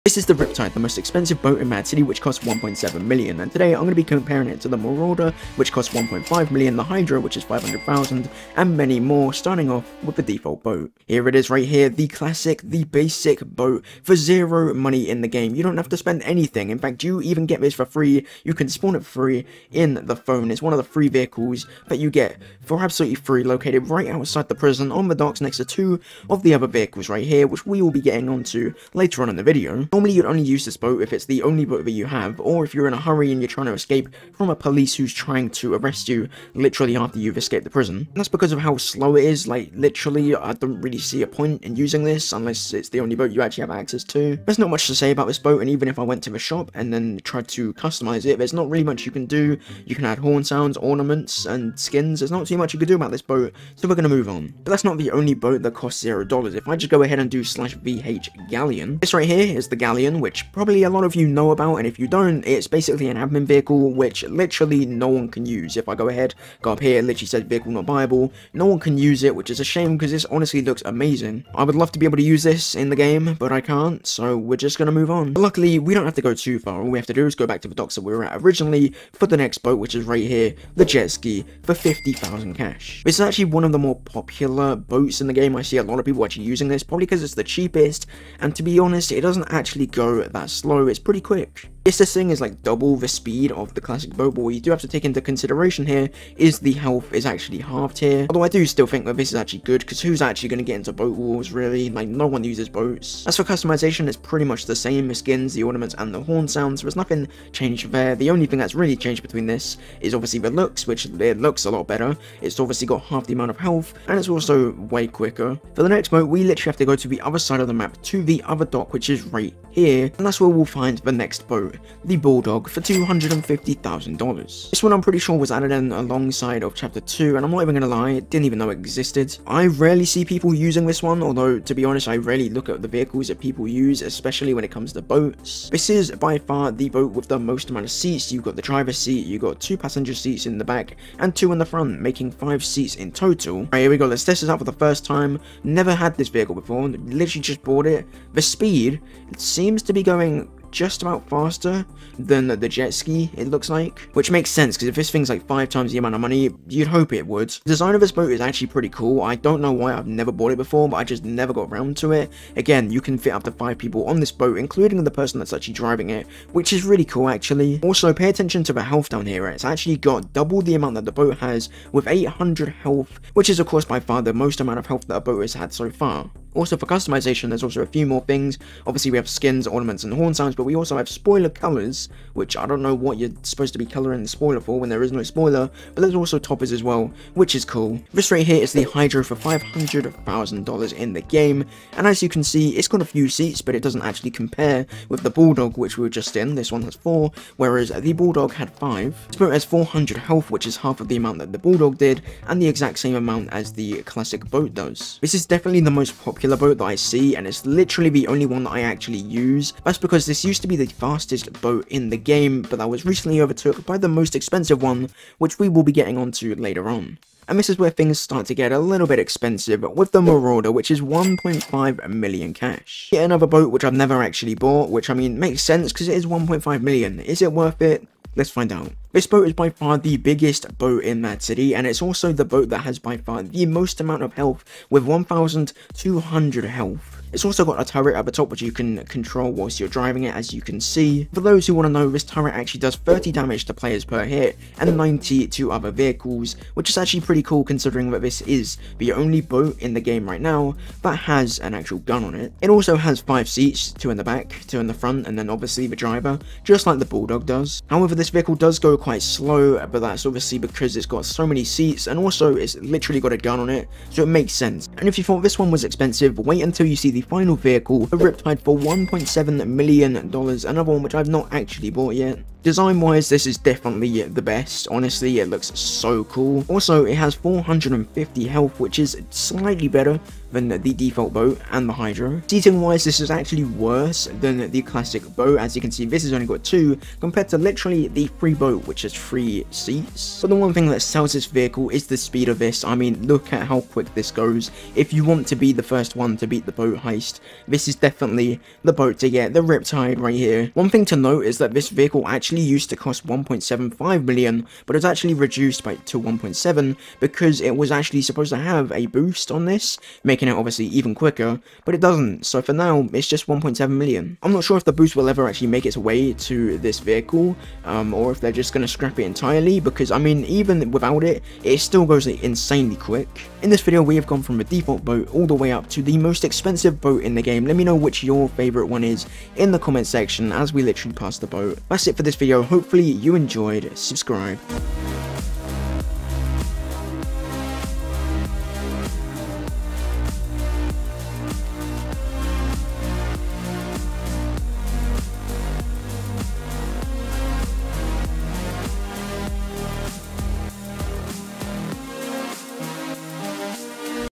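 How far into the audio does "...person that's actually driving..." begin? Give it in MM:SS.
02:45.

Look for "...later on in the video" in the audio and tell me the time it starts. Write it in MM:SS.
00:28.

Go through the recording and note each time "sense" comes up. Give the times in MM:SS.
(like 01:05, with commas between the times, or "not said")
02:34, 03:45, 04:24.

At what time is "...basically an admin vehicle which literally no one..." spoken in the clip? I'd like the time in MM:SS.
01:02.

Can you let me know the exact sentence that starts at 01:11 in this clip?
I would love to be able to use this in the game, but I can't, so we're just gonna move on.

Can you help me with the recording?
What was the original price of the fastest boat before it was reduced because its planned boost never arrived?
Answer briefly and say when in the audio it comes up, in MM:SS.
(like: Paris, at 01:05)
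1.75 million, at 05:03.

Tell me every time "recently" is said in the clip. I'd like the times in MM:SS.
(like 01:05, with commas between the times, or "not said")
03:33.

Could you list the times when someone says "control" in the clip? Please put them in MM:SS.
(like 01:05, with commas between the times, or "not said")
03:59.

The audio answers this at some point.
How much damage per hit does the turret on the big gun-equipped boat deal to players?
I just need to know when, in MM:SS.
04:02.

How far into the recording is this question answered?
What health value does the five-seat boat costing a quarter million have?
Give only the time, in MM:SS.
02:52.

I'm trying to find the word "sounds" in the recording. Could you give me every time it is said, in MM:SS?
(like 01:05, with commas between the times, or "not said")
00:50, 01:46, 03:00.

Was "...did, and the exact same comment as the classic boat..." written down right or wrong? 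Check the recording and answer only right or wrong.
wrong.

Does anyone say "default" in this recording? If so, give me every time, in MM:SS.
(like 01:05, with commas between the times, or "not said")
00:10, 04:40, 05:24.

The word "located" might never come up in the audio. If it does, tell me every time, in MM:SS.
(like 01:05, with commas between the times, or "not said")
00:23.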